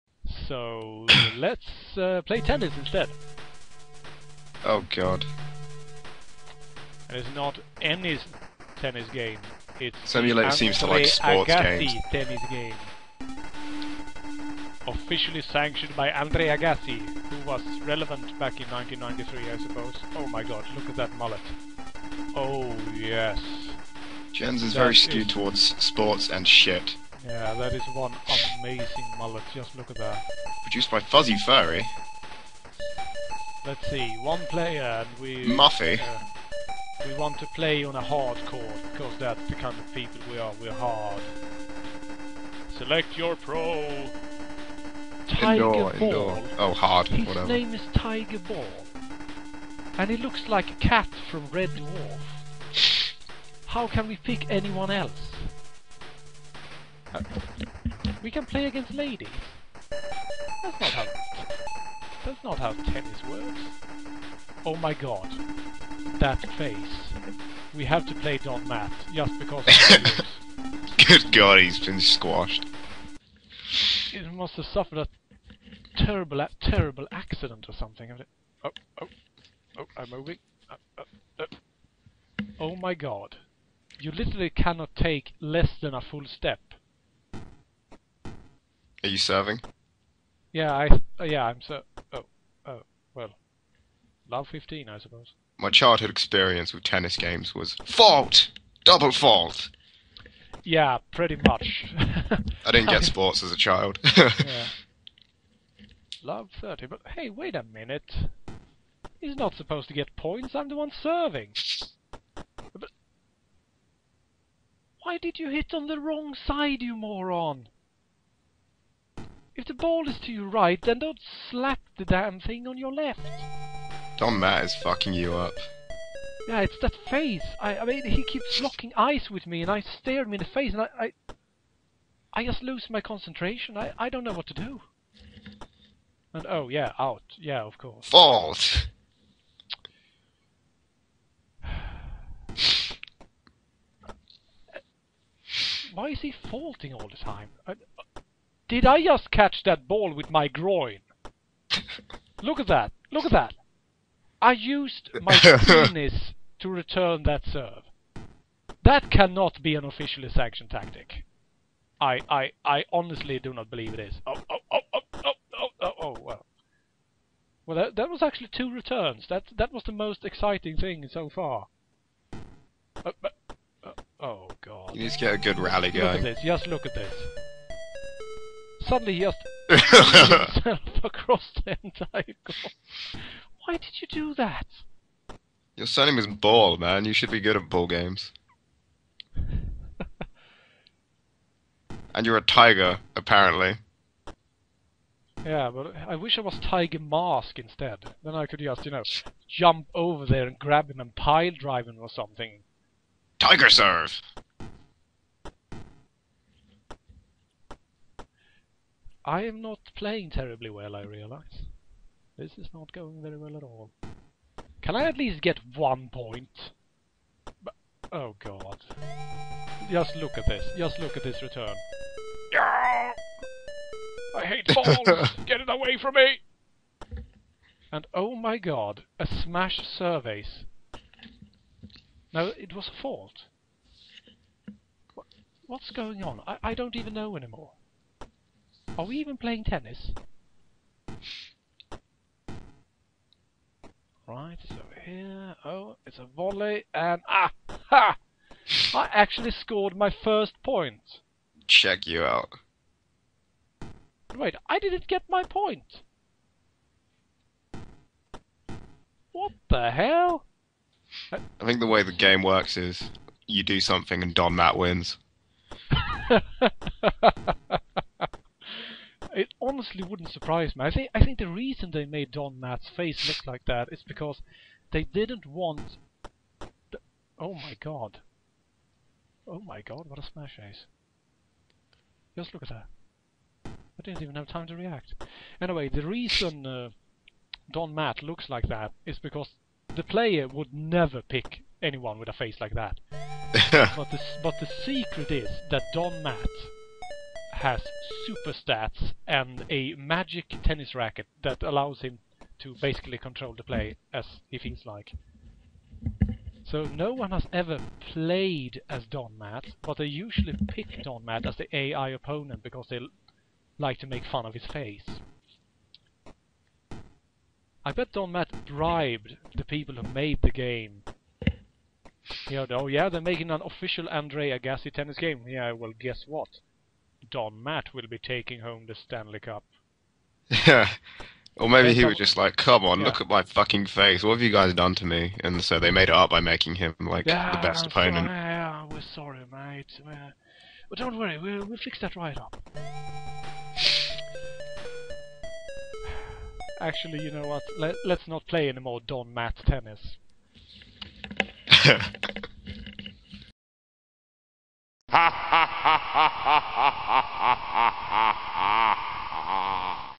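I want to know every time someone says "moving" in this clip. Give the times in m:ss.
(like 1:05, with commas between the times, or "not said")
1:20.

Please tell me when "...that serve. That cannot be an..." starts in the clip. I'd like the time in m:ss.
2:37.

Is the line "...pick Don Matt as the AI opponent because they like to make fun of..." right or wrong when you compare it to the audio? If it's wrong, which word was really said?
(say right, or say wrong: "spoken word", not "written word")
right.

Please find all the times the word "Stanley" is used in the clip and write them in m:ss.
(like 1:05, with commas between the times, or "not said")
5:28.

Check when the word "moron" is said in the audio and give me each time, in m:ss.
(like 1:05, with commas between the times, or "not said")
1:56.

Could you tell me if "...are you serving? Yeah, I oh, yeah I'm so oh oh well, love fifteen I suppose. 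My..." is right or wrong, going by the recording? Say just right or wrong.
right.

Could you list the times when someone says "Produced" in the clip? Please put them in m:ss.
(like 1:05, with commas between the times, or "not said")
0:30.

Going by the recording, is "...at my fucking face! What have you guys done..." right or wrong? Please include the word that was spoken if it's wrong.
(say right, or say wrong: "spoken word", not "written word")
right.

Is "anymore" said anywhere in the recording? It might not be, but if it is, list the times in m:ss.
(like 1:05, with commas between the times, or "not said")
3:57.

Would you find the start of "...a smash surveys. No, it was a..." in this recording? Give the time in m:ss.
3:49.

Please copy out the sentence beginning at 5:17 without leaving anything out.
I bet Don Matt bribed the people who made the game.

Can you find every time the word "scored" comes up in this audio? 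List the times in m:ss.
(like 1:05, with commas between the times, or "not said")
4:09.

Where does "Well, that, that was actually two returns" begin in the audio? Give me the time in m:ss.
2:47.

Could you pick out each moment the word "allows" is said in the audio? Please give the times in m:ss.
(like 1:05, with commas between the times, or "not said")
5:01.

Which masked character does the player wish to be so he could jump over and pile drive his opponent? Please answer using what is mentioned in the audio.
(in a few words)
Tiger Mask.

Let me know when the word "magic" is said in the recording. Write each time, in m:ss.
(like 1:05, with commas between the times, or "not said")
4:59.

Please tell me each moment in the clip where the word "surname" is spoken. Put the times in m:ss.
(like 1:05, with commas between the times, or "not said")
3:05.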